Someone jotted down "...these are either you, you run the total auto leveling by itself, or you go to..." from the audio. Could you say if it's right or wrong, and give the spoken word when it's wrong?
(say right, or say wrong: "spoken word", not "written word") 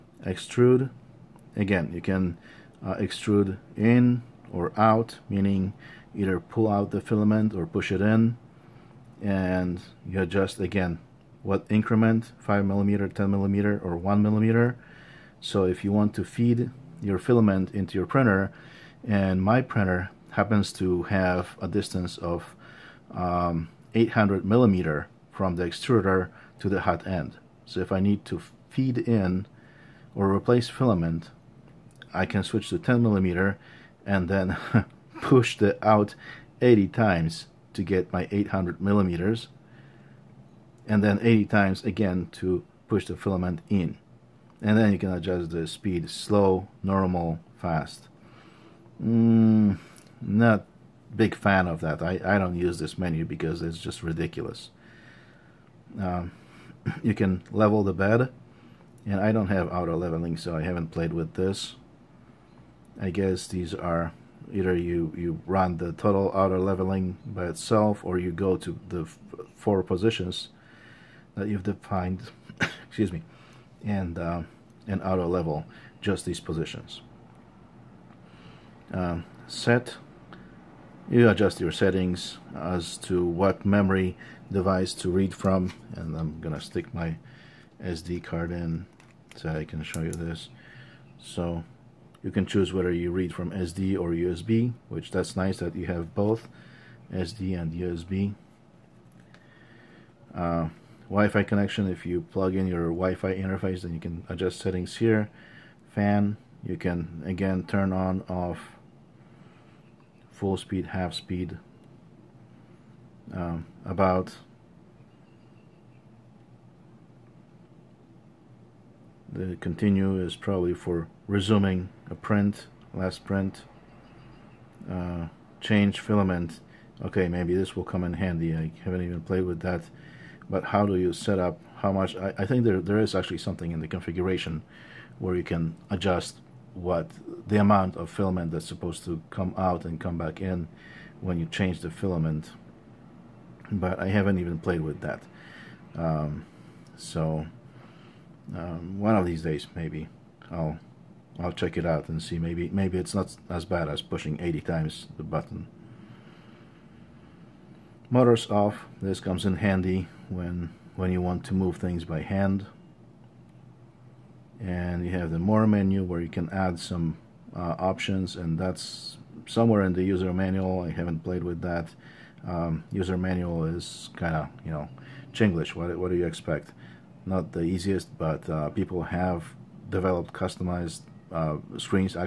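right.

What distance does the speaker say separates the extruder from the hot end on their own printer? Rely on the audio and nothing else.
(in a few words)
800 millimeters.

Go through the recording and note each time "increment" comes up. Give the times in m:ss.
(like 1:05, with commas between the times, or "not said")
0:11.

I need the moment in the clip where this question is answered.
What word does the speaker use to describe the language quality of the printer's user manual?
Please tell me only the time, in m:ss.
2:55.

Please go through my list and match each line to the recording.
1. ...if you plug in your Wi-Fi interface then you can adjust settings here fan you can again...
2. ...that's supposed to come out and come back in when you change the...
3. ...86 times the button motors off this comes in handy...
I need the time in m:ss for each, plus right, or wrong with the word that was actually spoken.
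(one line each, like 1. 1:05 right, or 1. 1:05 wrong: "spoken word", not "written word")
1. 1:41 right
2. 2:18 right
3. 2:34 wrong: "80", not "86".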